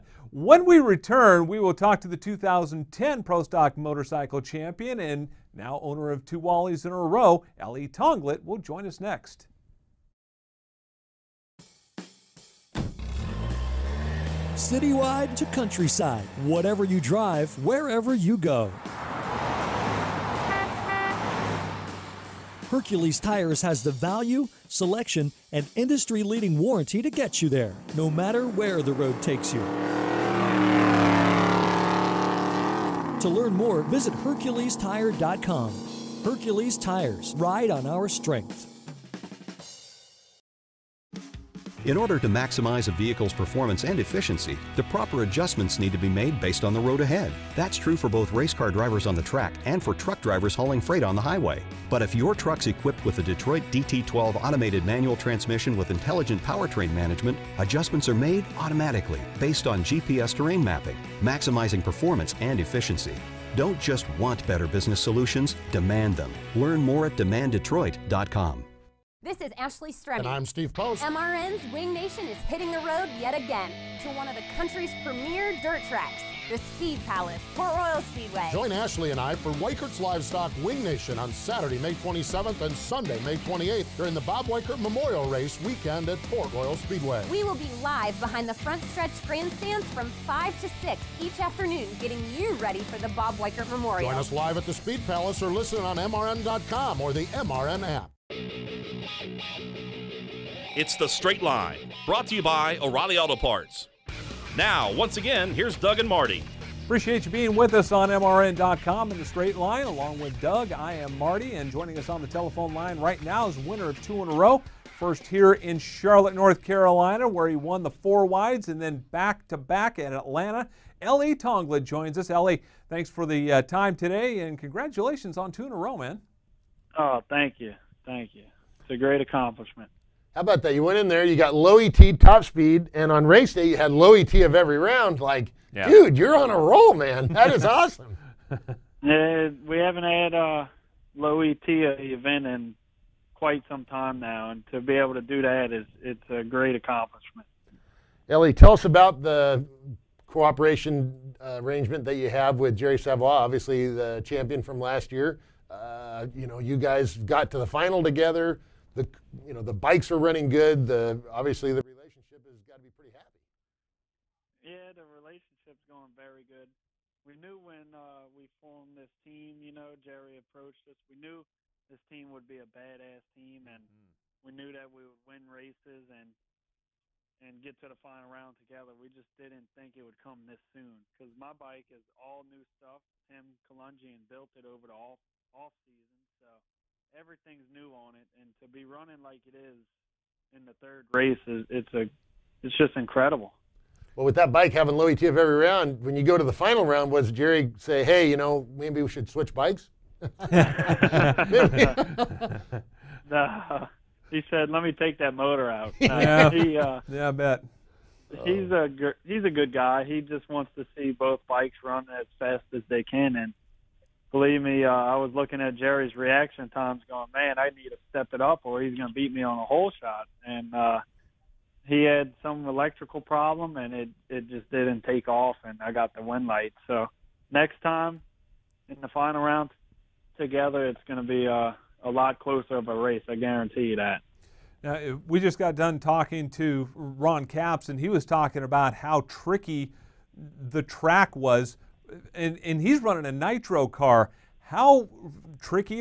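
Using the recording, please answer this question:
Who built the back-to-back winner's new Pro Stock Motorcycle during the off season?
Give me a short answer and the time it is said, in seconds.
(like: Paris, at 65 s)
Tim Kulungian, at 183 s.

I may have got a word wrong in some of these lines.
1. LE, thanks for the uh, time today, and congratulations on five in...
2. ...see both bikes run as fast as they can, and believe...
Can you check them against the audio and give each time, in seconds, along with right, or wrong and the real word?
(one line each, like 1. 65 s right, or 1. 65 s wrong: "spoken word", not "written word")
1. 122 s wrong: "two", not "five"
2. 210 s right.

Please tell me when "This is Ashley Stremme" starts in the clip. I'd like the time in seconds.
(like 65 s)
69 s.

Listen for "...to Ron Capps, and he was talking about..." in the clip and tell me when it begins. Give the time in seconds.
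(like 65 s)
236 s.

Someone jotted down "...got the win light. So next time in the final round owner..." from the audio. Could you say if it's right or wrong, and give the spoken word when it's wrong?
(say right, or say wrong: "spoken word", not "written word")
wrong: "together", not "owner".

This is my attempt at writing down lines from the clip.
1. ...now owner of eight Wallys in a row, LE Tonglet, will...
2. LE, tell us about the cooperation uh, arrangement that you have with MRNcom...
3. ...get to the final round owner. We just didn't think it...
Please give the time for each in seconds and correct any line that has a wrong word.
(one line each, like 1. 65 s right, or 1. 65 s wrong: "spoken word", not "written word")
1. 5 s wrong: "two", not "eight"
2. 148 s wrong: "Jerry", not "MRNcom"
3. 177 s wrong: "together", not "owner".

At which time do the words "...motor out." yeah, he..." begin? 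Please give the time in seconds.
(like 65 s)
205 s.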